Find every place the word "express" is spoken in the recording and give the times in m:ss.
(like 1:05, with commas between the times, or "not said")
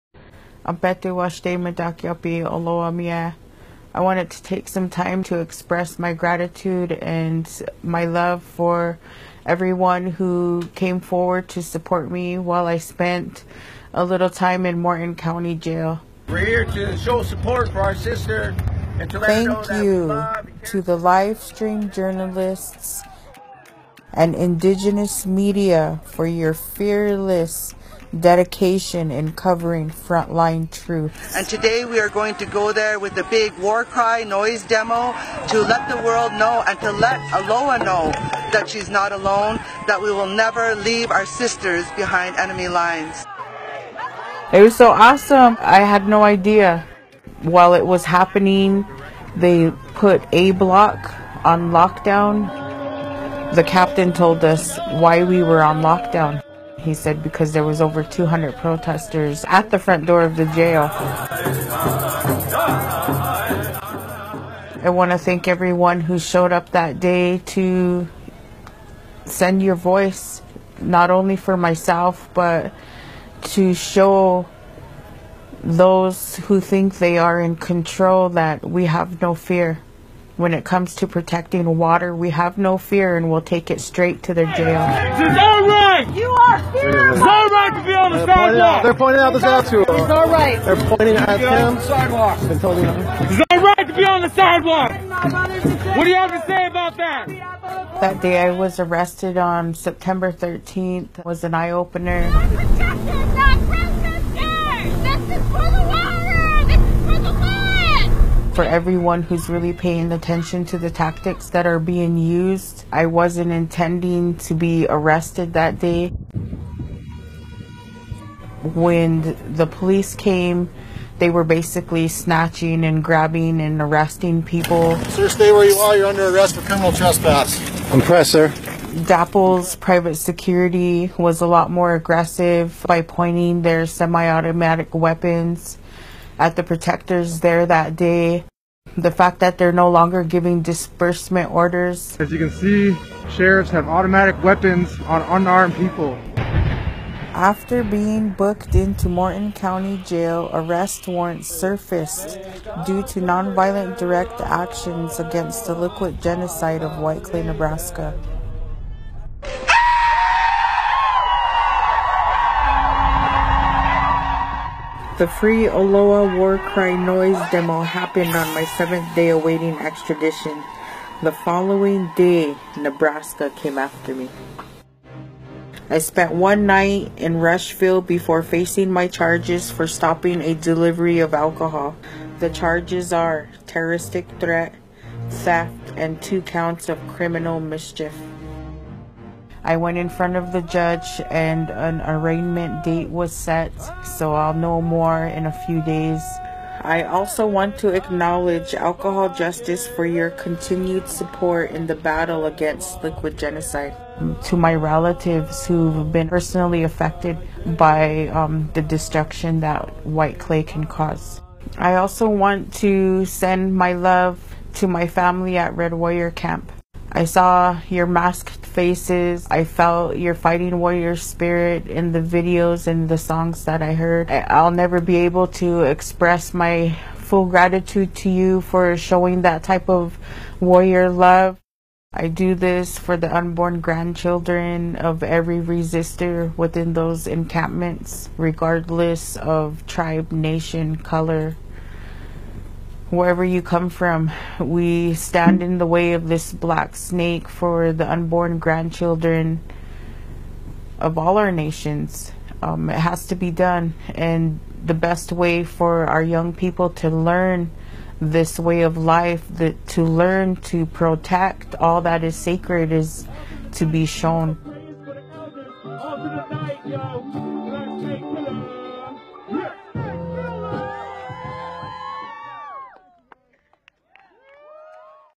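0:05, 3:45.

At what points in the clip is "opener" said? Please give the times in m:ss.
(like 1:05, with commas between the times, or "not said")
1:41.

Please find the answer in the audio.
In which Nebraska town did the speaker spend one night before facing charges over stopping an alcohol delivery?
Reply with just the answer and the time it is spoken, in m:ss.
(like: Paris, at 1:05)
Rushville, at 2:57.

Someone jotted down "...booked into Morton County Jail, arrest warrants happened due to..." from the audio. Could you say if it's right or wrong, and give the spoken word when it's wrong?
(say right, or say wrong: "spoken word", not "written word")
wrong: "surfaced", not "happened".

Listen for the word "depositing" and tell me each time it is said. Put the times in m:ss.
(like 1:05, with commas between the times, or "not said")
not said.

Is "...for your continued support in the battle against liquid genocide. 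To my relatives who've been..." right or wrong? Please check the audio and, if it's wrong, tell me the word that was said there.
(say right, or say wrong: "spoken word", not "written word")
right.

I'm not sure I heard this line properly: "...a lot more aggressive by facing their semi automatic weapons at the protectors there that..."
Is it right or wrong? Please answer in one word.
wrong.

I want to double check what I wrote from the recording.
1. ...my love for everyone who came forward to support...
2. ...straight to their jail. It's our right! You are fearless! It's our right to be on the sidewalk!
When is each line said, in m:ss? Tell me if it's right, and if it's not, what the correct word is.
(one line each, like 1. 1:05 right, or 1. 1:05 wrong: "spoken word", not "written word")
1. 0:07 right
2. 1:23 right.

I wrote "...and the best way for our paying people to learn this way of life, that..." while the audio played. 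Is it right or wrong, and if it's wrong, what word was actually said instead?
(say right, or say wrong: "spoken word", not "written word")
wrong: "young", not "paying".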